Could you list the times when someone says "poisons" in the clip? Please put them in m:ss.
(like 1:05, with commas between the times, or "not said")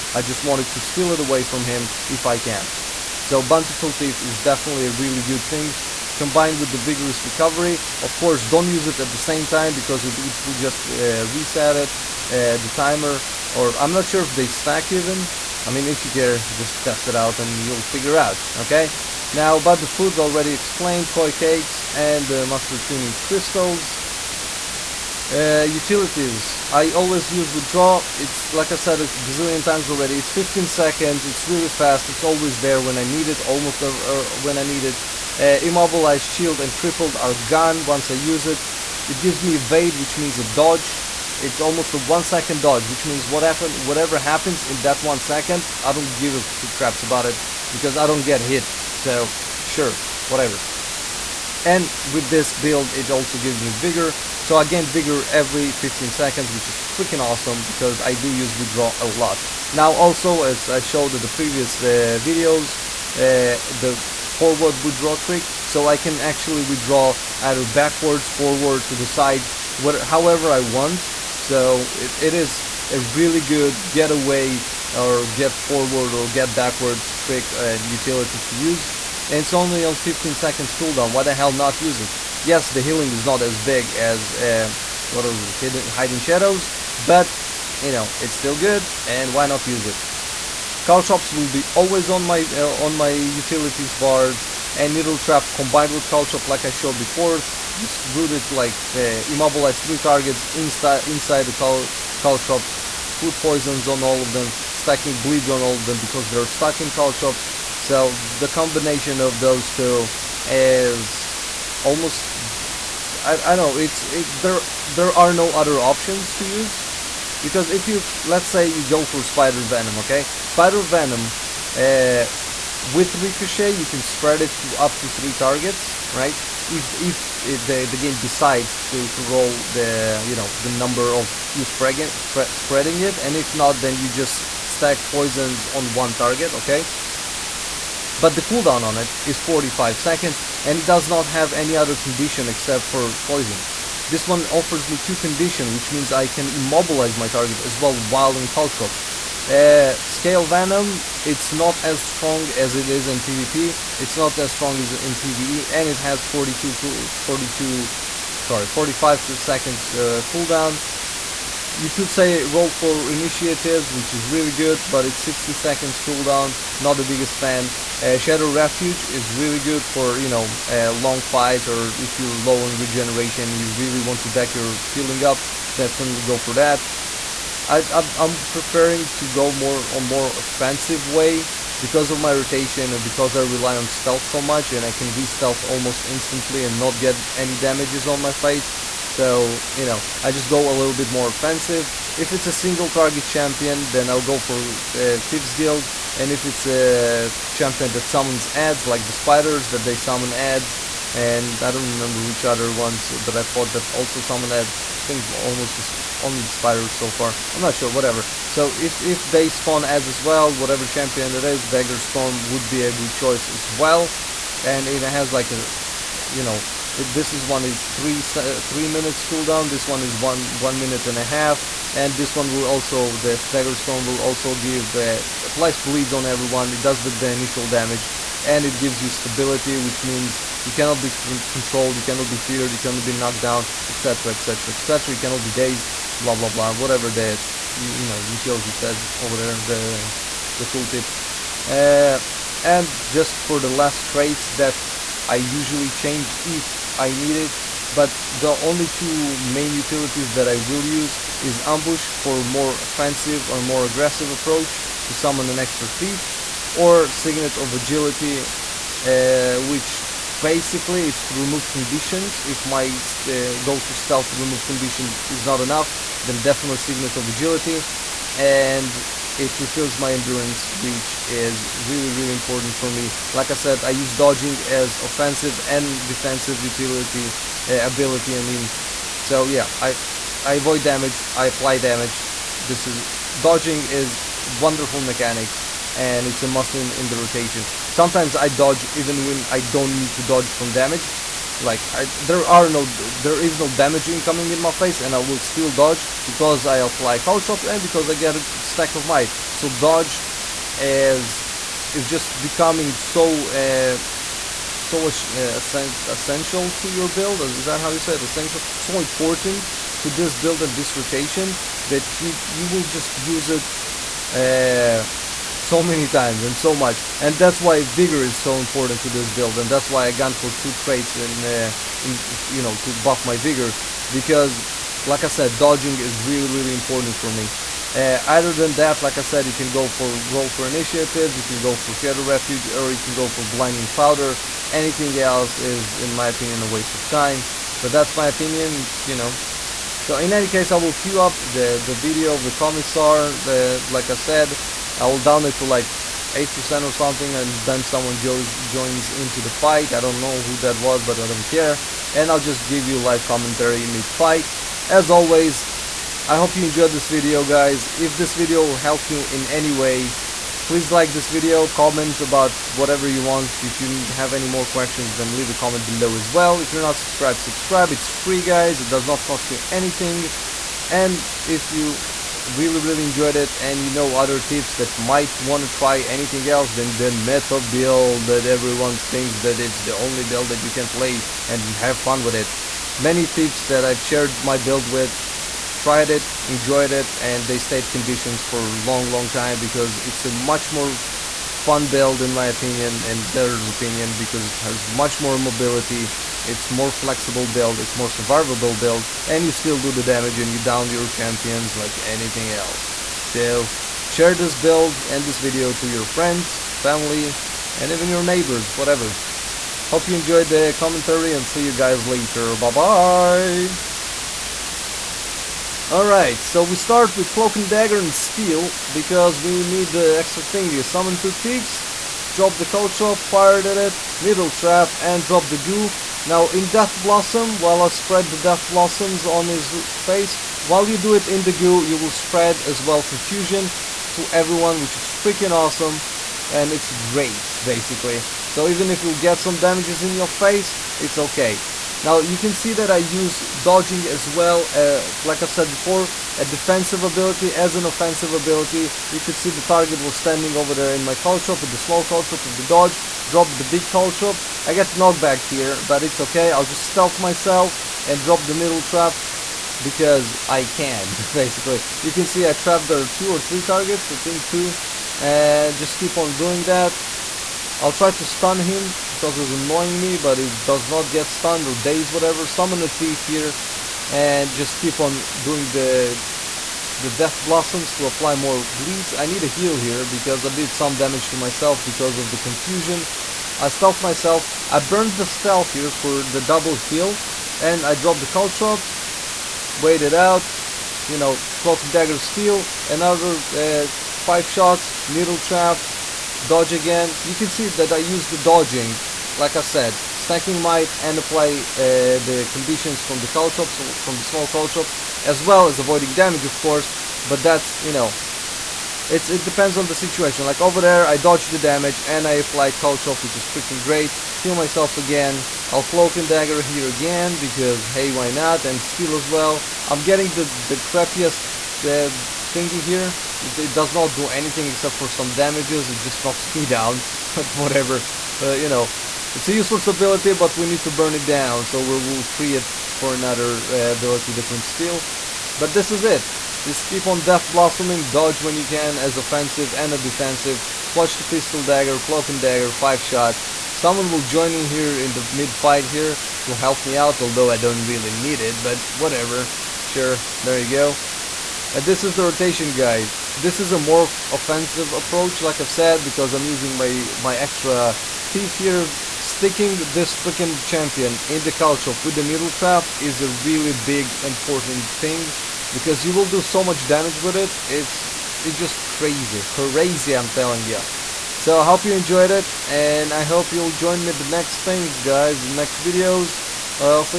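1:43, 2:15, 2:23.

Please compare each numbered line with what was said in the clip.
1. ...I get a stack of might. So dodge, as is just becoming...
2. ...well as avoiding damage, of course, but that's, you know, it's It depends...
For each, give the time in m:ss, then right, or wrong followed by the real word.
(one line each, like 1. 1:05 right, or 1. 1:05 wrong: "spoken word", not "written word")
1. 4:58 right
2. 8:25 right.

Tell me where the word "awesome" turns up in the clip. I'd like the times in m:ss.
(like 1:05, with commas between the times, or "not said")
0:57, 7:15.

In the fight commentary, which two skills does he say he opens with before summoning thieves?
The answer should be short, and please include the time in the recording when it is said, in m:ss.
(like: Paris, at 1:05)
Cloak and Dagger and Steal, at 6:57.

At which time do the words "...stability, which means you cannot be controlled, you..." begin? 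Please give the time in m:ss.
3:49.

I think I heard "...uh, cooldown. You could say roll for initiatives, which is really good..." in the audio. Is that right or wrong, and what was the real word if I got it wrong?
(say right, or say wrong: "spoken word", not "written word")
right.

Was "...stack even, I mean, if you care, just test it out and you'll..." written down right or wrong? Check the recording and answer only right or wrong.
right.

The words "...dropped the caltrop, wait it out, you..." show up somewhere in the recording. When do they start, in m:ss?
8:07.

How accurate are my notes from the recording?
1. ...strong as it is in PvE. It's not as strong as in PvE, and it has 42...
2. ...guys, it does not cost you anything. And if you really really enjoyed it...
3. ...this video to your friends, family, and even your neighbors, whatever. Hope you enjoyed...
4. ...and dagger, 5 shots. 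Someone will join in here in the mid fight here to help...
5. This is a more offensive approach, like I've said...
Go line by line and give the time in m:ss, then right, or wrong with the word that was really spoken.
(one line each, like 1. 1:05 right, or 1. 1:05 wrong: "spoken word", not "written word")
1. 2:32 wrong: "PvP", not "PvE"
2. 6:08 right
3. 6:45 right
4. 9:02 right
5. 9:13 right.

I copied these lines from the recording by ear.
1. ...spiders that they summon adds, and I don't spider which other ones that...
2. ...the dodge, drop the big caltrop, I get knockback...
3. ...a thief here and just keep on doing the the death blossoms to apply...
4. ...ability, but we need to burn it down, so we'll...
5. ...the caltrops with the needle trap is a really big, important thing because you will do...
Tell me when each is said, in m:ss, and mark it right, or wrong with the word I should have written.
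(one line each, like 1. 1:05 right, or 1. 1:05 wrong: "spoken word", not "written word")
1. 3:19 wrong: "remember", not "spider"
2. 7:32 right
3. 7:52 right
4. 8:49 right
5. 9:21 right.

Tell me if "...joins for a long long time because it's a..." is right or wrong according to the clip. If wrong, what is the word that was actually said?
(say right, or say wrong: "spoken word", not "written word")
wrong: "conditions", not "joins".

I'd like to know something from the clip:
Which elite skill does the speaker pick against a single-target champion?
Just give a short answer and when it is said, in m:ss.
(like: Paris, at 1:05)
Thieves Guild, at 3:15.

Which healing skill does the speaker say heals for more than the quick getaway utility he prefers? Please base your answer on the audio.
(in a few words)
Hiding Shadows.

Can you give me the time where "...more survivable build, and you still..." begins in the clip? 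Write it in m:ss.
6:37.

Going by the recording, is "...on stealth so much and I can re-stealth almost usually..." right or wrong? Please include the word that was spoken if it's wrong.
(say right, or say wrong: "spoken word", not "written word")
wrong: "instantly", not "usually".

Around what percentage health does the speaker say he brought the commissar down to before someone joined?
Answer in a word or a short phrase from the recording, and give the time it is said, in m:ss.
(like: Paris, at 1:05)
8%, at 5:46.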